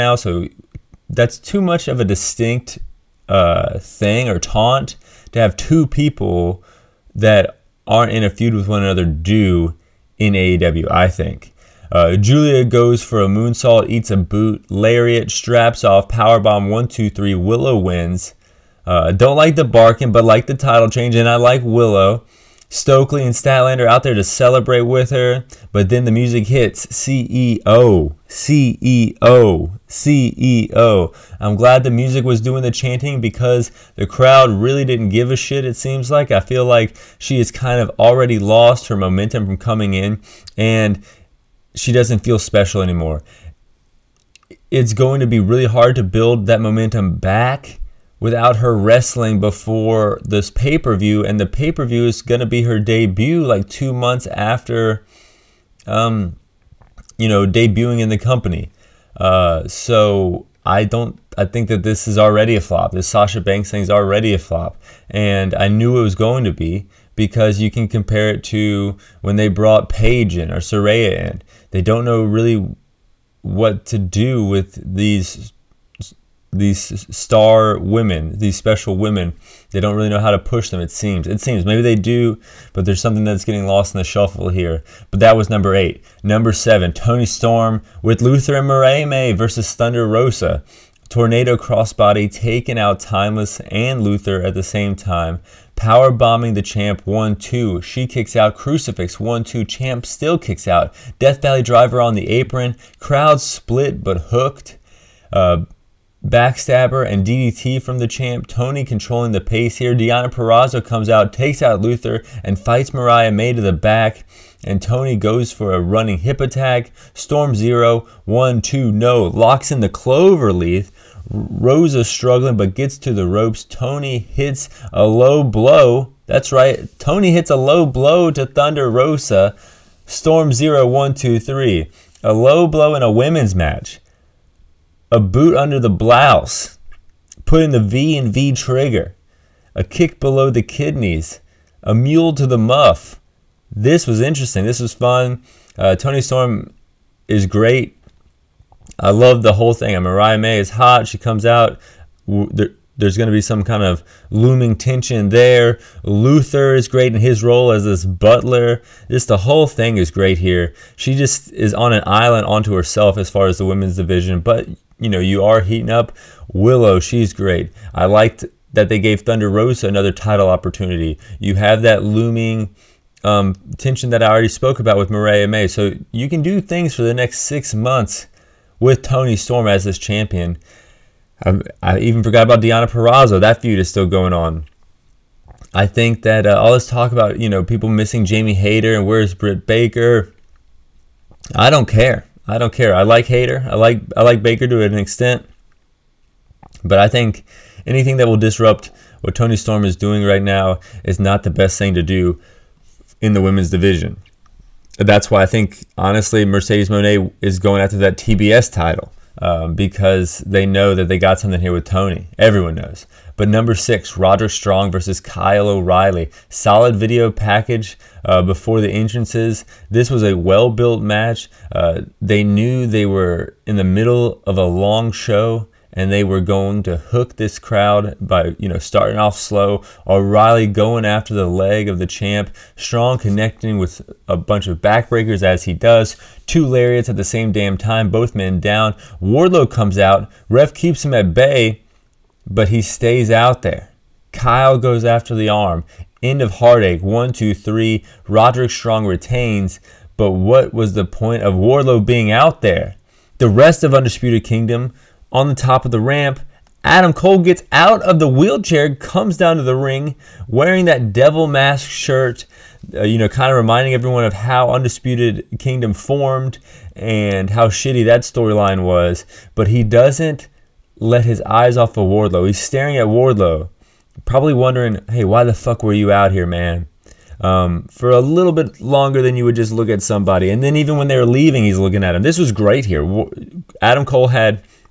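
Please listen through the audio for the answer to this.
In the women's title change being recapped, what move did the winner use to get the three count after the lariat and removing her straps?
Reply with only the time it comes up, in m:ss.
0:16.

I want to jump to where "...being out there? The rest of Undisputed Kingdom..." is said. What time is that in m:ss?
4:12.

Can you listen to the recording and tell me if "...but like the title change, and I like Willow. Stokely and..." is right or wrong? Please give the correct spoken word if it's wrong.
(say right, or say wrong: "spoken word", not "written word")
right.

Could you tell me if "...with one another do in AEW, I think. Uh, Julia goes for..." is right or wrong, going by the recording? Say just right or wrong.
right.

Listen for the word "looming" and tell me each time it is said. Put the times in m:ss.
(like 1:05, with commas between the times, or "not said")
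2:34, 2:52.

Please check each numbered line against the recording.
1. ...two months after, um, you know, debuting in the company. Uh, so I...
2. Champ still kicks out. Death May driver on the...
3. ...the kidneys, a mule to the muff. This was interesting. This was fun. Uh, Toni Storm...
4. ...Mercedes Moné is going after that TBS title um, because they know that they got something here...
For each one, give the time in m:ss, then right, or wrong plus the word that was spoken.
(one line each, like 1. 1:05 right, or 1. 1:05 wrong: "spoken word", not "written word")
1. 0:53 right
2. 1:39 wrong: "Valley", not "May"
3. 2:20 right
4. 3:26 right.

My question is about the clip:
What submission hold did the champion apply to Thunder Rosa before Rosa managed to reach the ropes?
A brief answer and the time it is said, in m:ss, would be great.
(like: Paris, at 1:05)
Clover leaf, at 1:59.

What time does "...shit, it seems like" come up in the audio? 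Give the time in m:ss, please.
0:35.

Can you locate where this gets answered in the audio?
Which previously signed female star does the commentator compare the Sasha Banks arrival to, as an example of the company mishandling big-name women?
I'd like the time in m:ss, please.
1:10.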